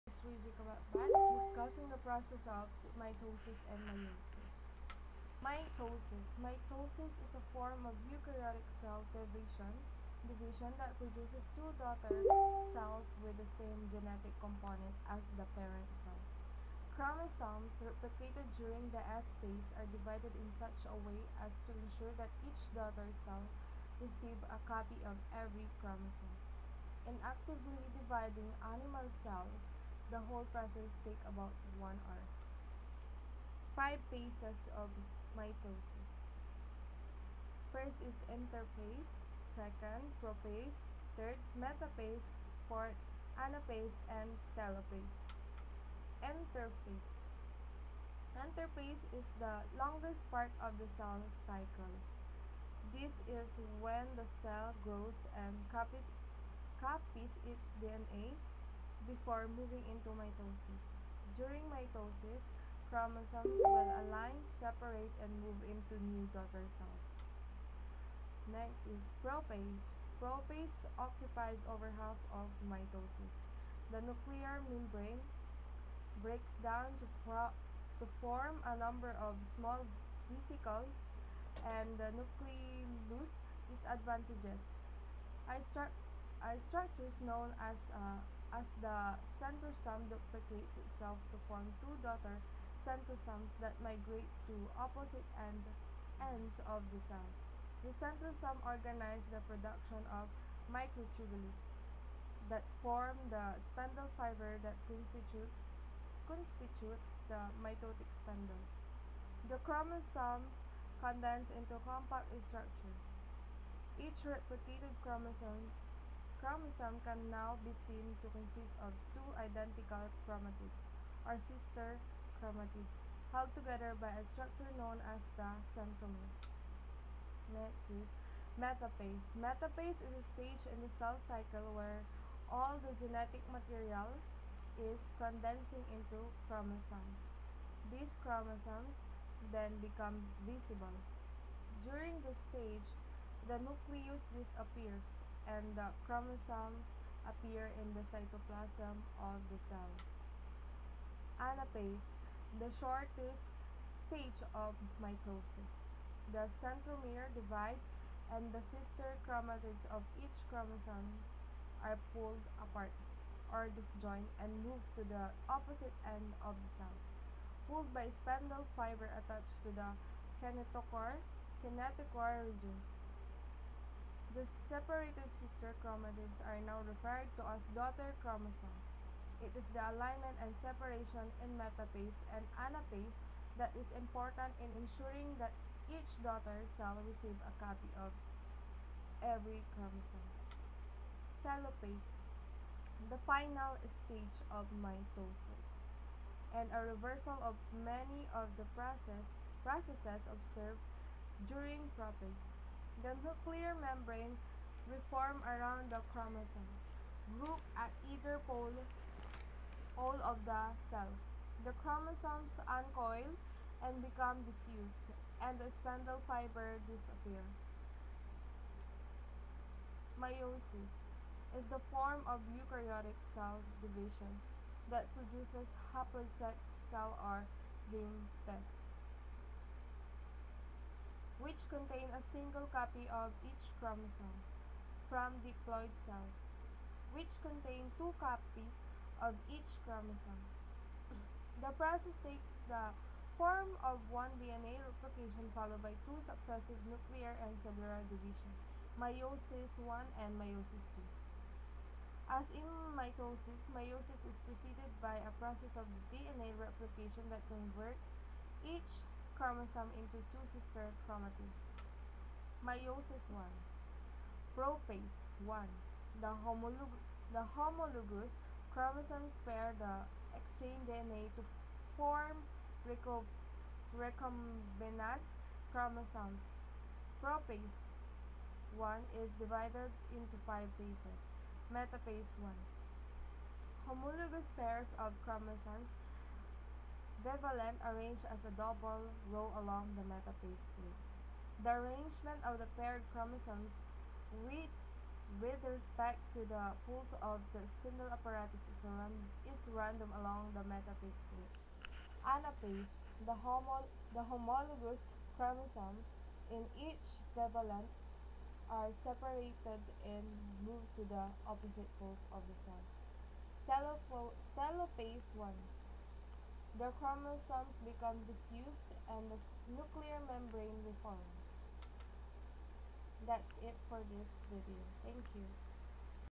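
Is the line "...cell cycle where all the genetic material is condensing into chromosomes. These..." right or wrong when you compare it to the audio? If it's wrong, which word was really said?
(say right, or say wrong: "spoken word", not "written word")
right.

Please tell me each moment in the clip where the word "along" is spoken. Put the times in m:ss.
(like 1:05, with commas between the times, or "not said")
4:49, 5:00.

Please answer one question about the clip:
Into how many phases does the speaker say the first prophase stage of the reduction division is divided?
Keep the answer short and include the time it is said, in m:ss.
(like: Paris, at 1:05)
5, at 4:40.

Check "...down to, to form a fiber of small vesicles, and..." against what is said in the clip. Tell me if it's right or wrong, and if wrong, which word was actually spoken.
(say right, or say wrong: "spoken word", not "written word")
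wrong: "number", not "fiber".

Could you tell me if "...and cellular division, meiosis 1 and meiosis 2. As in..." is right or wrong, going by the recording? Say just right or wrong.
right.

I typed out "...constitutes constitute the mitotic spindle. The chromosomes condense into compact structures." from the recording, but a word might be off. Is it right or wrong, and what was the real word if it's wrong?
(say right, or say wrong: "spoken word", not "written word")
right.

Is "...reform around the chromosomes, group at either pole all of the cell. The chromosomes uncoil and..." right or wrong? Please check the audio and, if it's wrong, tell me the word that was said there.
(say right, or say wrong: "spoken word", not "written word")
right.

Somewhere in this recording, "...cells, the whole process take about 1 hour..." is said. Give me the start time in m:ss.
0:29.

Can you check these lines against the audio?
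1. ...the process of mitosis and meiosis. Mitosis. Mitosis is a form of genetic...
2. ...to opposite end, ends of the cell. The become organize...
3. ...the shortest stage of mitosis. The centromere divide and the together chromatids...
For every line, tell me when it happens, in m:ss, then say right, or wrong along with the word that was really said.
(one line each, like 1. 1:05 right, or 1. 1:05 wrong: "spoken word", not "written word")
1. 0:01 wrong: "eukaryotic", not "genetic"
2. 1:34 wrong: "centrosome", not "become"
3. 2:32 wrong: "sister", not "together".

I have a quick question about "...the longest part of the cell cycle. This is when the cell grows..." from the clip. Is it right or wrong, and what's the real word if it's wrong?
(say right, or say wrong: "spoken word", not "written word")
right.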